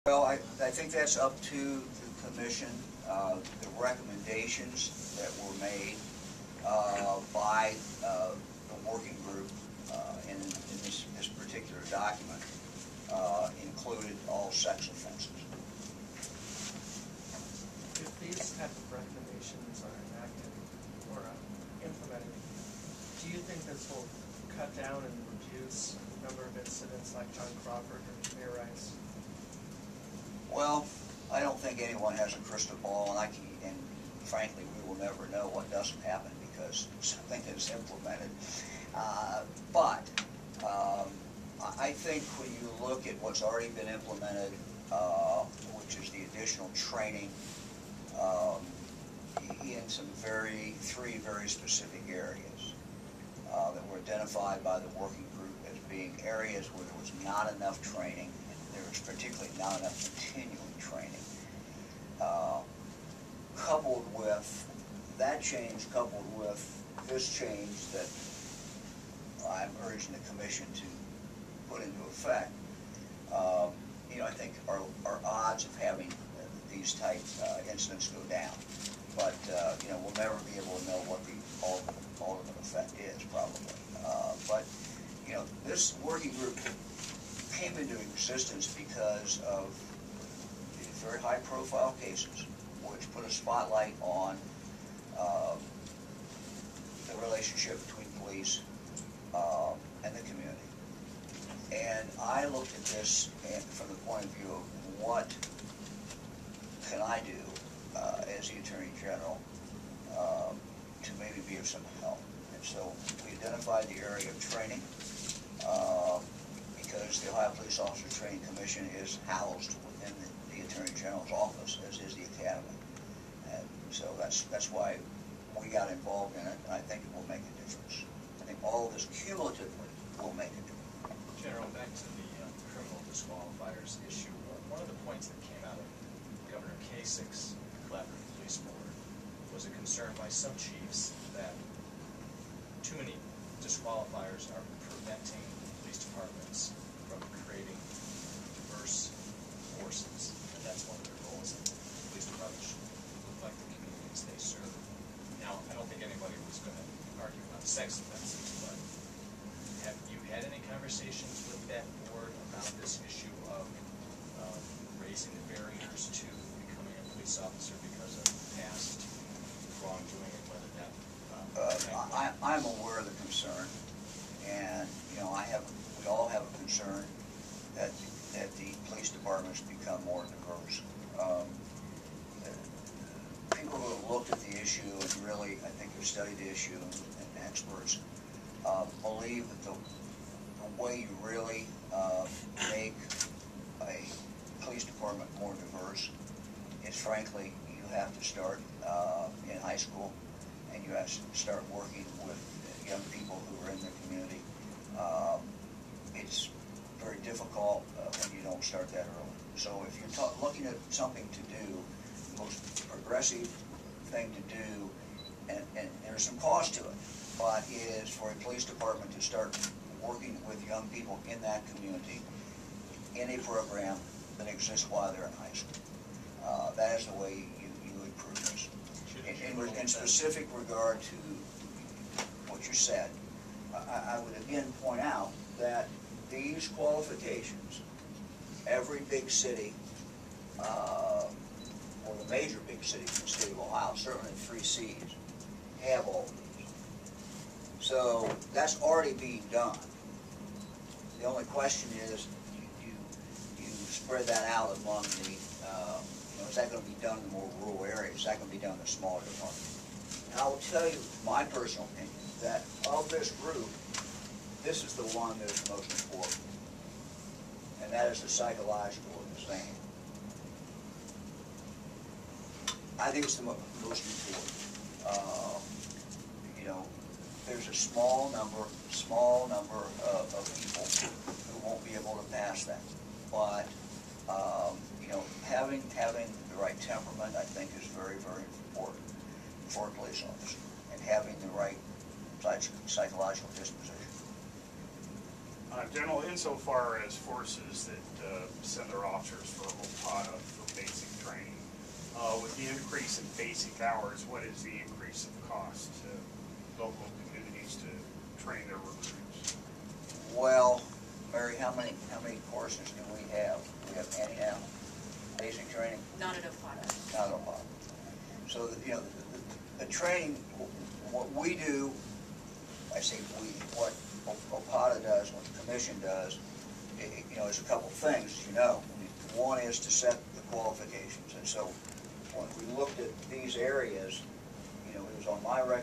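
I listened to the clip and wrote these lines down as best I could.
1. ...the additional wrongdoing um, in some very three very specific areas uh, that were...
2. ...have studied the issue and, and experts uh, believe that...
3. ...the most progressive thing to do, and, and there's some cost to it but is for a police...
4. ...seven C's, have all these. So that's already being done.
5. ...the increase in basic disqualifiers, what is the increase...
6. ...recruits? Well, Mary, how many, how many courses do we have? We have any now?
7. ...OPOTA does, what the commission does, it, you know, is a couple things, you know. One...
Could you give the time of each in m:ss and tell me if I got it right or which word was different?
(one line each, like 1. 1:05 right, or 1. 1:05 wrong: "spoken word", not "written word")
1. 0:46 wrong: "training", not "wrongdoing"
2. 3:05 right
3. 3:32 right
4. 4:04 wrong: "three", not "seven"
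5. 5:02 wrong: "hours", not "disqualifiers"
6. 5:08 right
7. 5:24 right.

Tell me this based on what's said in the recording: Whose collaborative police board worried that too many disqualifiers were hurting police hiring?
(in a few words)
Governor Kasich.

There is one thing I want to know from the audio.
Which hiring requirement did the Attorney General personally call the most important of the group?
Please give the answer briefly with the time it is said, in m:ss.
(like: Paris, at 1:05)
The psychological exam, at 4:28.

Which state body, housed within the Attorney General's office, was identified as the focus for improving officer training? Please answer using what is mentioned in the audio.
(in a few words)
Ohio Police Officer Training Commission.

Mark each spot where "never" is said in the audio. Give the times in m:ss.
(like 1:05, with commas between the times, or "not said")
0:34, 1:20.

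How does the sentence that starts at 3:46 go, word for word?
Uh, that is the way you, you improve this.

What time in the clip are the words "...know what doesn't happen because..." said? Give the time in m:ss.
0:35.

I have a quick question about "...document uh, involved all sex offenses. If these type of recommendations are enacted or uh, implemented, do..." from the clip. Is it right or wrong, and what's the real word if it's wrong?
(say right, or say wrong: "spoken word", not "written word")
wrong: "included", not "involved".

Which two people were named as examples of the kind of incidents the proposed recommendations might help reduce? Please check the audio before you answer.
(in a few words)
John Crawford and Tamir Rice.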